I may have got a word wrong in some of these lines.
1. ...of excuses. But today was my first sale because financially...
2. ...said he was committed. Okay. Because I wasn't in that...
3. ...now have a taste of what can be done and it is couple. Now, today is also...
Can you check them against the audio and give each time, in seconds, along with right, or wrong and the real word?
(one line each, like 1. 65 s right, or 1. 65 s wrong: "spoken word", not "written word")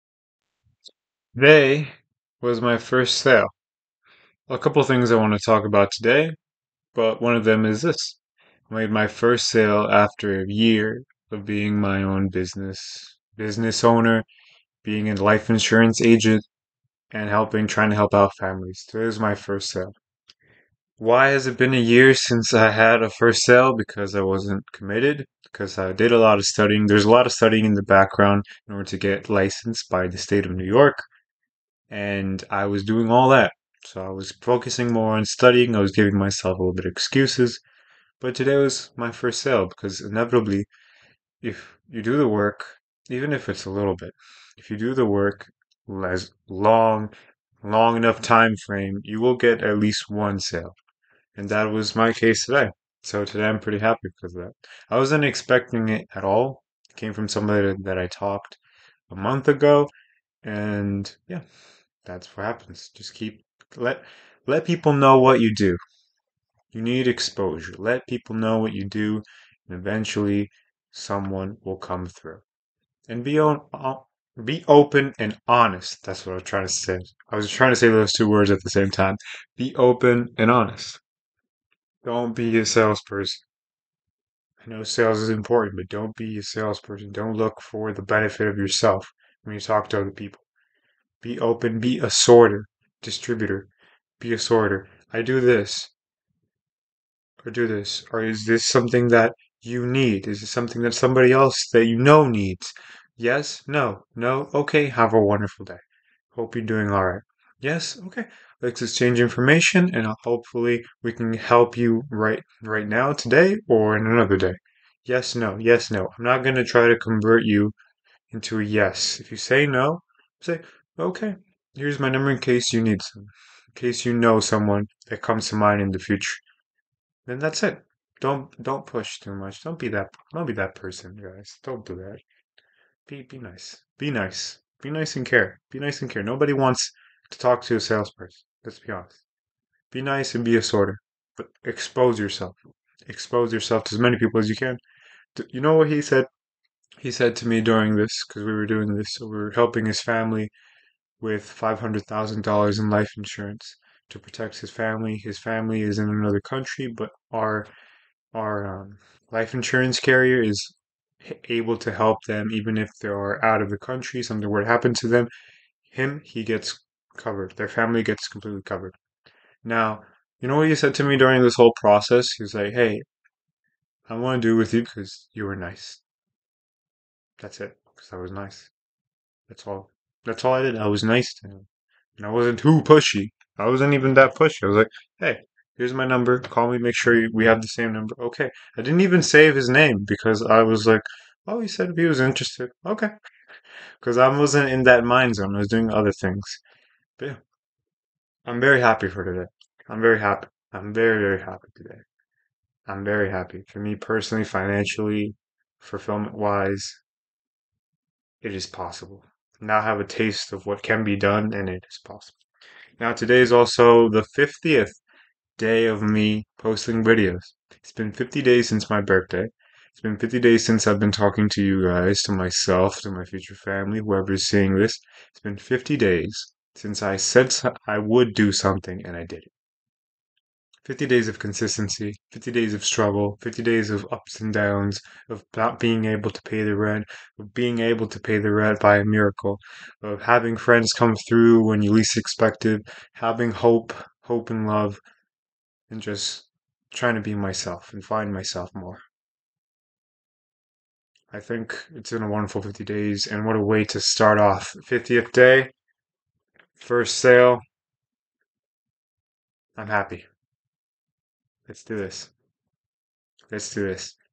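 1. 36 s wrong: "inevitably", not "financially"
2. 191 s wrong: "interested", not "committed"
3. 209 s wrong: "possible", not "couple".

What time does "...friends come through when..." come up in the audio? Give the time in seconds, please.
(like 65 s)
240 s.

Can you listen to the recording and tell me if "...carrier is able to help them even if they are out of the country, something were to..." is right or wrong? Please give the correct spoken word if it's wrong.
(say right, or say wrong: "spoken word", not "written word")
right.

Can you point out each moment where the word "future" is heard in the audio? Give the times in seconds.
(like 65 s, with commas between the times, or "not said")
125 s, 223 s.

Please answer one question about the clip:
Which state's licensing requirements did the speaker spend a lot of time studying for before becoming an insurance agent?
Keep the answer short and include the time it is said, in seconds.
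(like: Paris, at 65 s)
New York, at 30 s.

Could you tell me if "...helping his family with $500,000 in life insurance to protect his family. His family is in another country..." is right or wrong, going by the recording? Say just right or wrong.
right.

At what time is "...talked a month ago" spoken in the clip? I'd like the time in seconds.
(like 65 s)
58 s.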